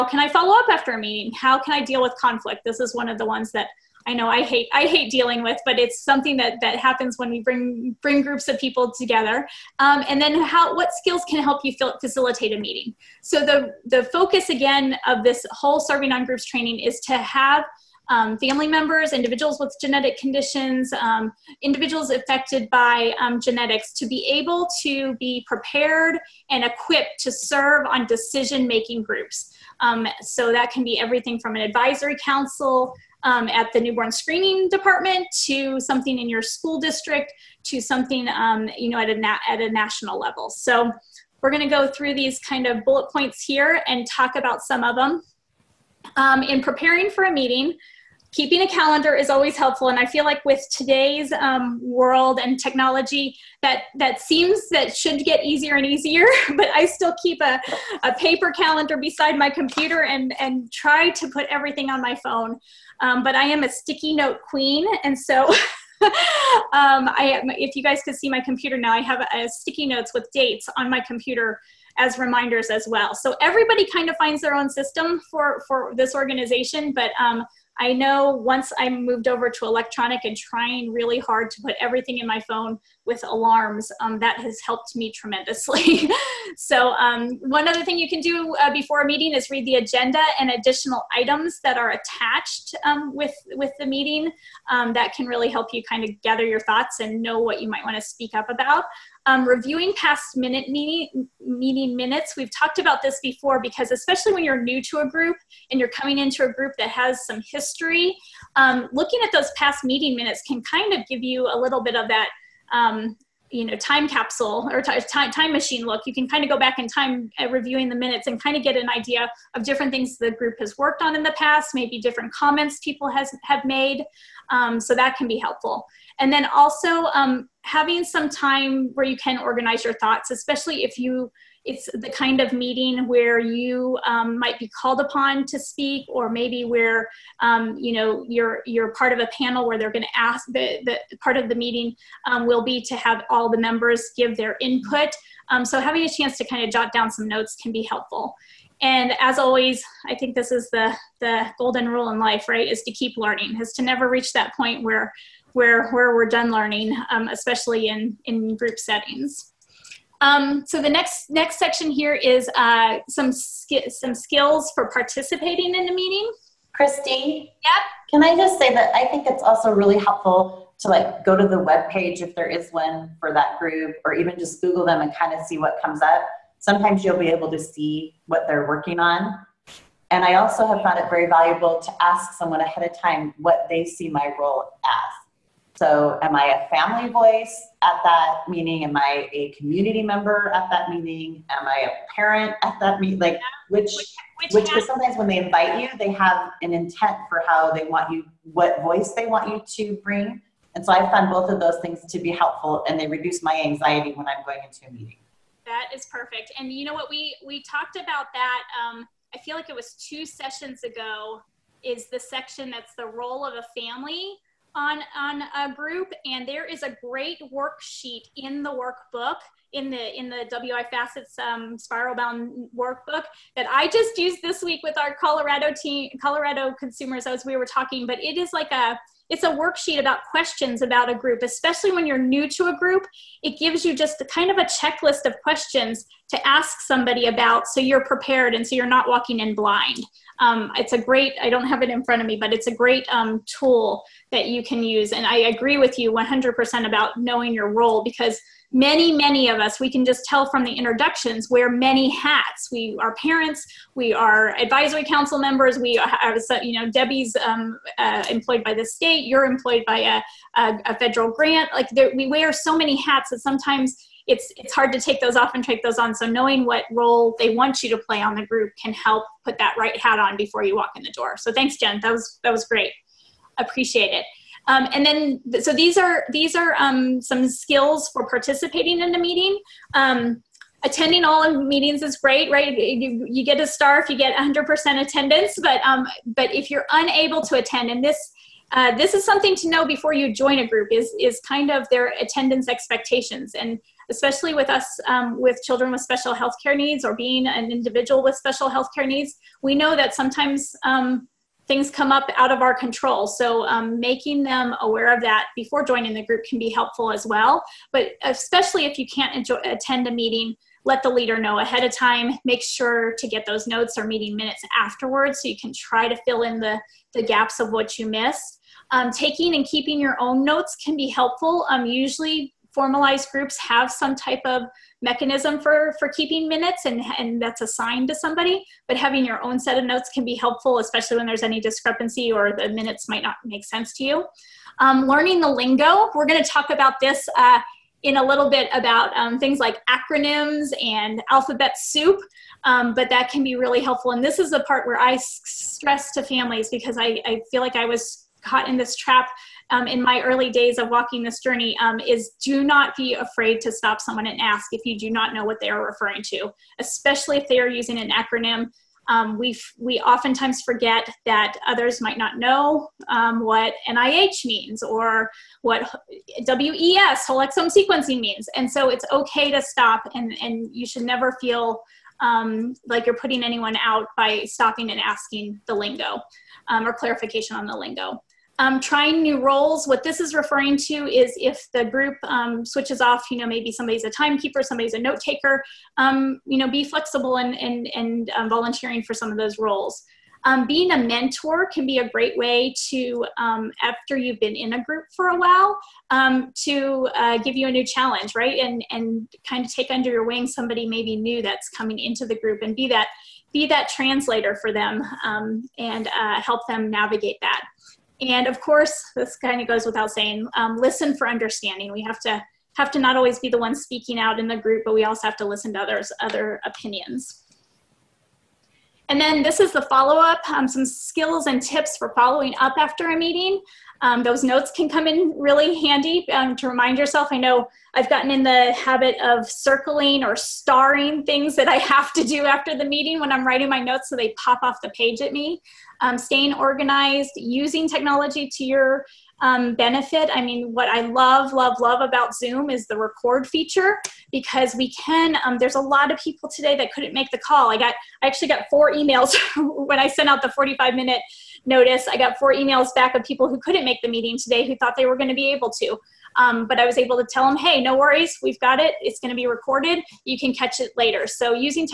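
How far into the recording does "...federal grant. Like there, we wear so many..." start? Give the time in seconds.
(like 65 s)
260 s.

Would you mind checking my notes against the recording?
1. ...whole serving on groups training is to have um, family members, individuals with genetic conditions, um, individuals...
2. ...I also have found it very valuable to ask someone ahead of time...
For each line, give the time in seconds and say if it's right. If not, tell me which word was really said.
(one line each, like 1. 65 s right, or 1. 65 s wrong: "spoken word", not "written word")
1. 15 s right
2. 180 s right.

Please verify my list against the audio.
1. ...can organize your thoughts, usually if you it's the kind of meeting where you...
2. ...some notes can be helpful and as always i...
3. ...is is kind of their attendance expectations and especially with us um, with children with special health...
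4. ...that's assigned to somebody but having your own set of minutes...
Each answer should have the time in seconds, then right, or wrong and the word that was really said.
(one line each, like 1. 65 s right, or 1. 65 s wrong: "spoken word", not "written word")
1. 129 s wrong: "especially", not "usually"
2. 147 s right
3. 290 s right
4. 327 s wrong: "notes", not "minutes".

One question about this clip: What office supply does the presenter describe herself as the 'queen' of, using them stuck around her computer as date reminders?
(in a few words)
sticky notes.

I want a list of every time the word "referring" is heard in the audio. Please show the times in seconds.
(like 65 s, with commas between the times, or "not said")
355 s, 380 s.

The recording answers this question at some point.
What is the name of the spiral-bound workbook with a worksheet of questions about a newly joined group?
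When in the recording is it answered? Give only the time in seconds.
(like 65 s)
220 s.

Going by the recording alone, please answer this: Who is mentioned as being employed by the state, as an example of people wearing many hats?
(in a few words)
Debbie.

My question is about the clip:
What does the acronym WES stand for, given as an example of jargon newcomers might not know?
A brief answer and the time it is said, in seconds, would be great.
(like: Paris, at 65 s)
whole exome sequencing, at 367 s.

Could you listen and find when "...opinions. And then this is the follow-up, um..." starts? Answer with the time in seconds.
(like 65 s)
416 s.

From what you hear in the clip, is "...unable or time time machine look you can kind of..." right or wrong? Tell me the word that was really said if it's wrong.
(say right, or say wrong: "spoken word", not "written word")
wrong: "capsule", not "unable".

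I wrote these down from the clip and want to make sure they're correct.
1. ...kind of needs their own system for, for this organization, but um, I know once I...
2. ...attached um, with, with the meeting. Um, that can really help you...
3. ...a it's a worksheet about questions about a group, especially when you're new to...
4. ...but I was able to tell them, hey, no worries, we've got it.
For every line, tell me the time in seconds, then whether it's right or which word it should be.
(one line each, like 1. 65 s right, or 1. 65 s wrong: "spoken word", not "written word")
1. 73 s wrong: "finds", not "needs"
2. 91 s right
3. 228 s right
4. 456 s right.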